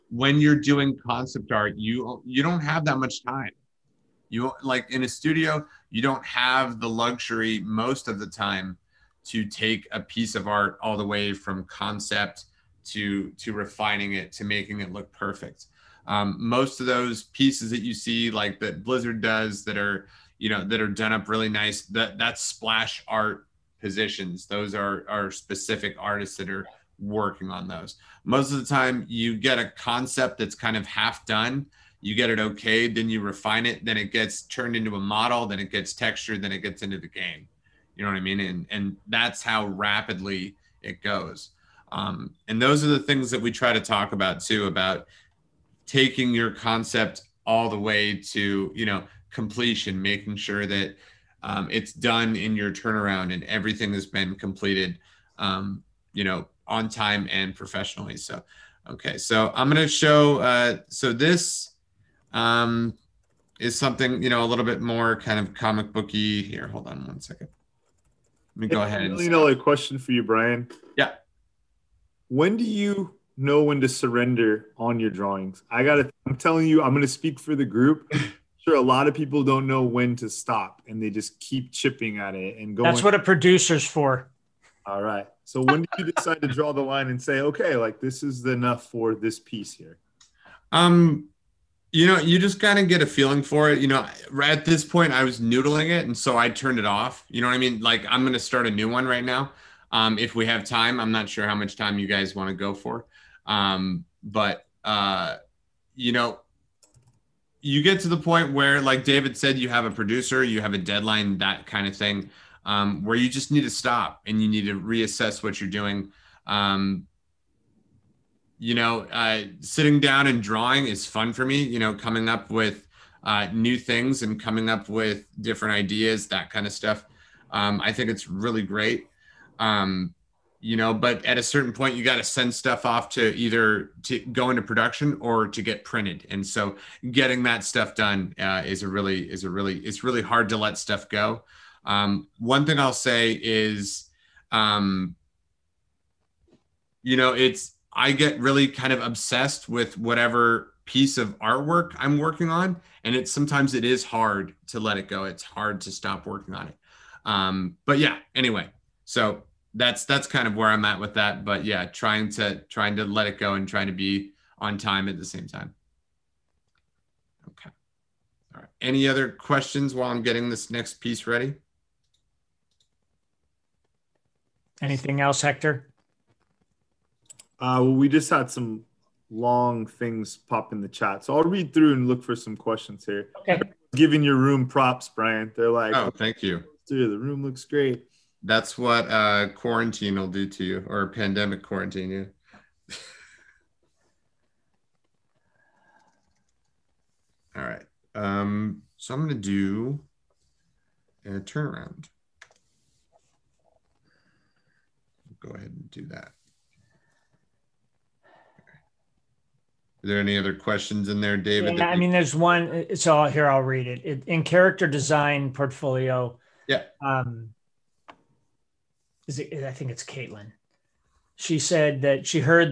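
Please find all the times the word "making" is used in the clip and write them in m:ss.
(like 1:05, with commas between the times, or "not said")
0:14, 0:50.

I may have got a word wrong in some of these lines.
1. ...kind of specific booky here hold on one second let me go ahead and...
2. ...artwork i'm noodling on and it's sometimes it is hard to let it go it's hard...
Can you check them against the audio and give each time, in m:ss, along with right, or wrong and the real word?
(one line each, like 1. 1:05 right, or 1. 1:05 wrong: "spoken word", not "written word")
1. 1:05 wrong: "comic", not "specific"
2. 2:31 wrong: "working", not "noodling".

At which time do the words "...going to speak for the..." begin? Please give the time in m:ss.
1:16.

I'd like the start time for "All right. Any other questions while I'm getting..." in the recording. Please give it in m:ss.
2:48.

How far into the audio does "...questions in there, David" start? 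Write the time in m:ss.
3:30.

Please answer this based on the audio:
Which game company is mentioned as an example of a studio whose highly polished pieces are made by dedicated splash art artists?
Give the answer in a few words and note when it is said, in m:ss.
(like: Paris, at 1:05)
Blizzard, at 0:18.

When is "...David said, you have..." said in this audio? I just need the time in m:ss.
1:49.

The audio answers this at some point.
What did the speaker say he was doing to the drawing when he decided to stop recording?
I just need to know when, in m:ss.
1:35.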